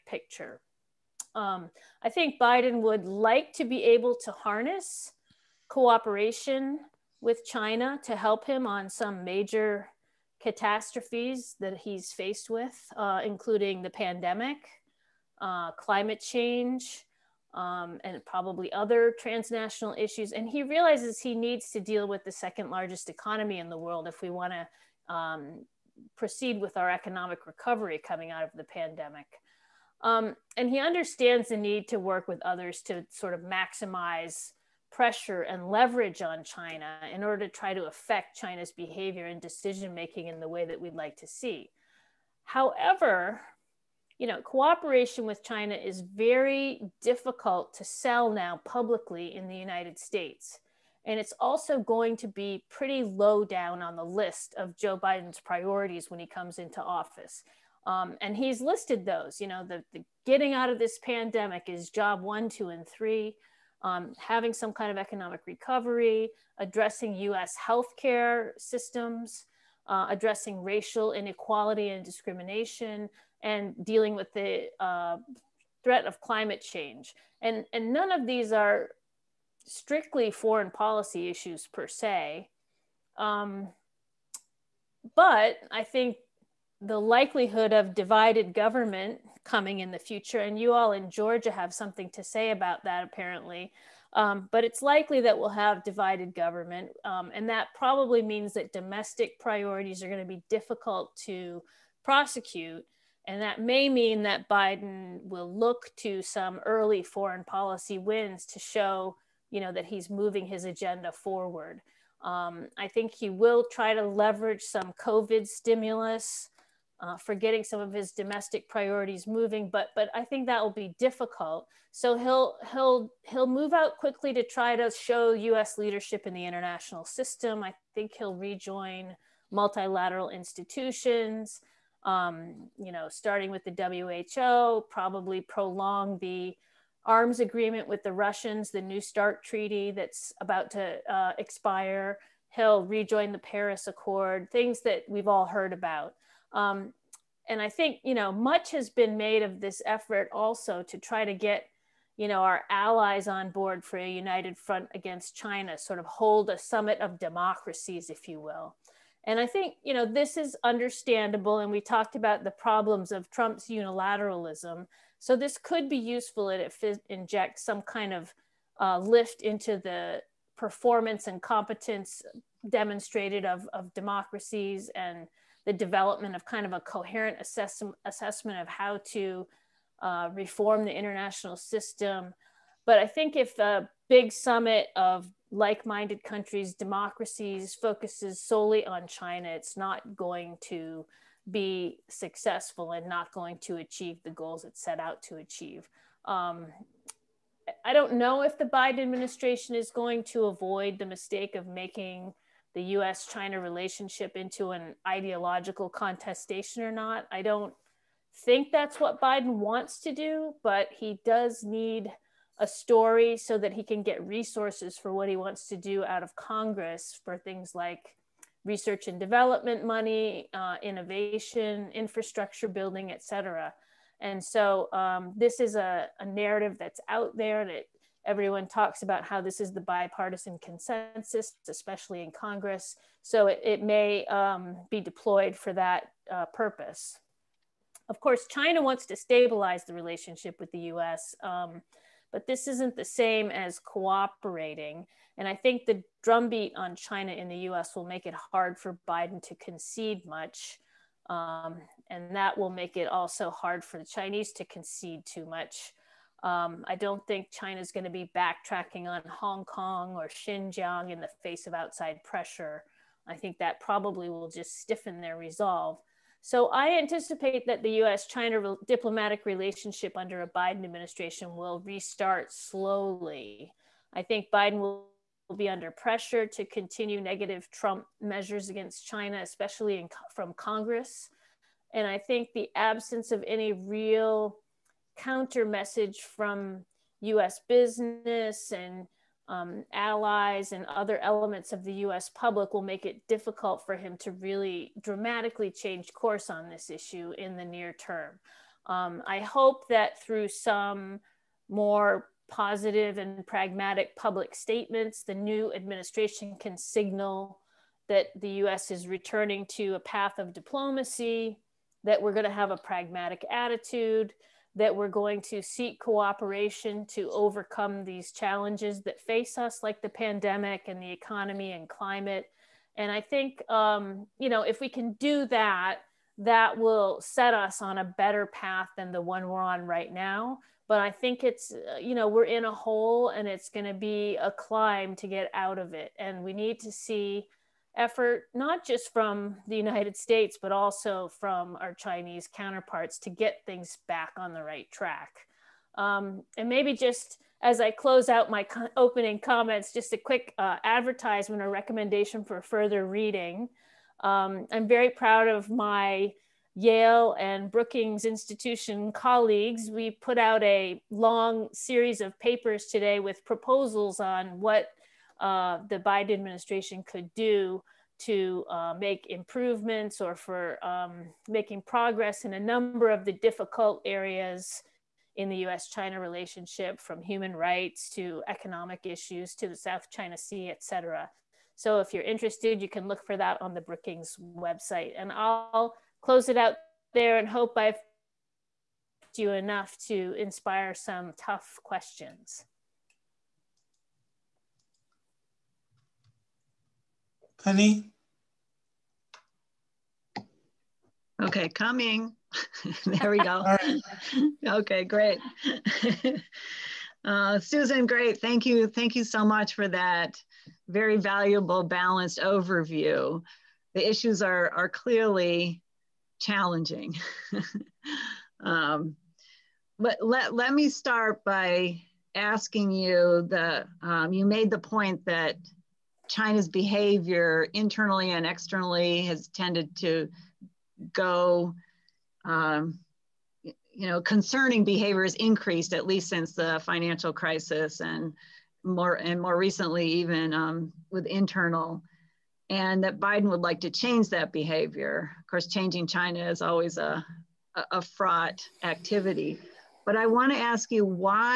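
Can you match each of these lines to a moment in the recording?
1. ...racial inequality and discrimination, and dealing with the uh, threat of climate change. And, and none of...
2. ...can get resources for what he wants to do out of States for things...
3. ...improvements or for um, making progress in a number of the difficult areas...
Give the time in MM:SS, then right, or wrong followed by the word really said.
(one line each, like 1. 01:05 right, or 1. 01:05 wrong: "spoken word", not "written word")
1. 01:10 right
2. 03:33 wrong: "Congress", not "States"
3. 06:09 right.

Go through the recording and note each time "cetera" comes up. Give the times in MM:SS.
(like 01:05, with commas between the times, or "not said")
03:43, 06:20.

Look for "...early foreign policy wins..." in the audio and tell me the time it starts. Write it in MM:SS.
01:46.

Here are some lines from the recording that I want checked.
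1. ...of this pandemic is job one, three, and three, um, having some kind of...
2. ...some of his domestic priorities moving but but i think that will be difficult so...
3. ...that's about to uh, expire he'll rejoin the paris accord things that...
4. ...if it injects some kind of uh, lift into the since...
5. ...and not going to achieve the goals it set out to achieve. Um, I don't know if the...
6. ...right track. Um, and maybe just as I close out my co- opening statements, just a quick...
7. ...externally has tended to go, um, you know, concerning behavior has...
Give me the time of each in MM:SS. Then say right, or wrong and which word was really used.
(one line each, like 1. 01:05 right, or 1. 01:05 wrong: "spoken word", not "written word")
1. 01:00 wrong: "two", not "three"
2. 01:57 right
3. 02:19 right
4. 02:46 wrong: "performance", not "since"
5. 03:12 right
6. 05:44 wrong: "comments", not "statements"
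7. 07:08 right.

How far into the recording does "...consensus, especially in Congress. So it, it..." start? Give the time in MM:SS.
03:50.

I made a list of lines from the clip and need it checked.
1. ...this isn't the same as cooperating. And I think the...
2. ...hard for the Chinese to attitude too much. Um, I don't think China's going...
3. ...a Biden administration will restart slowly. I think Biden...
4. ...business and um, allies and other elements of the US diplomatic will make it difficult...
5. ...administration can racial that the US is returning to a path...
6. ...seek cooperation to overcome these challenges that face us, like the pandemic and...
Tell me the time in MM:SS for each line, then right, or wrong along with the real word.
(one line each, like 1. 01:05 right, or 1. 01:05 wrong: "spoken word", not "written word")
1. 04:02 right
2. 04:13 wrong: "concede", not "attitude"
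3. 04:30 right
4. 04:47 wrong: "public", not "diplomatic"
5. 05:05 wrong: "signal", not "racial"
6. 05:15 right.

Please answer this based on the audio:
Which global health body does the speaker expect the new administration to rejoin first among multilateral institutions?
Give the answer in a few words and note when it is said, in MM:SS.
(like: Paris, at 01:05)
WHO, at 02:14.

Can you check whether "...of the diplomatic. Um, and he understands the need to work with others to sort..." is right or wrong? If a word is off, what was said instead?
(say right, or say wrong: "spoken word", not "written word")
wrong: "pandemic", not "diplomatic".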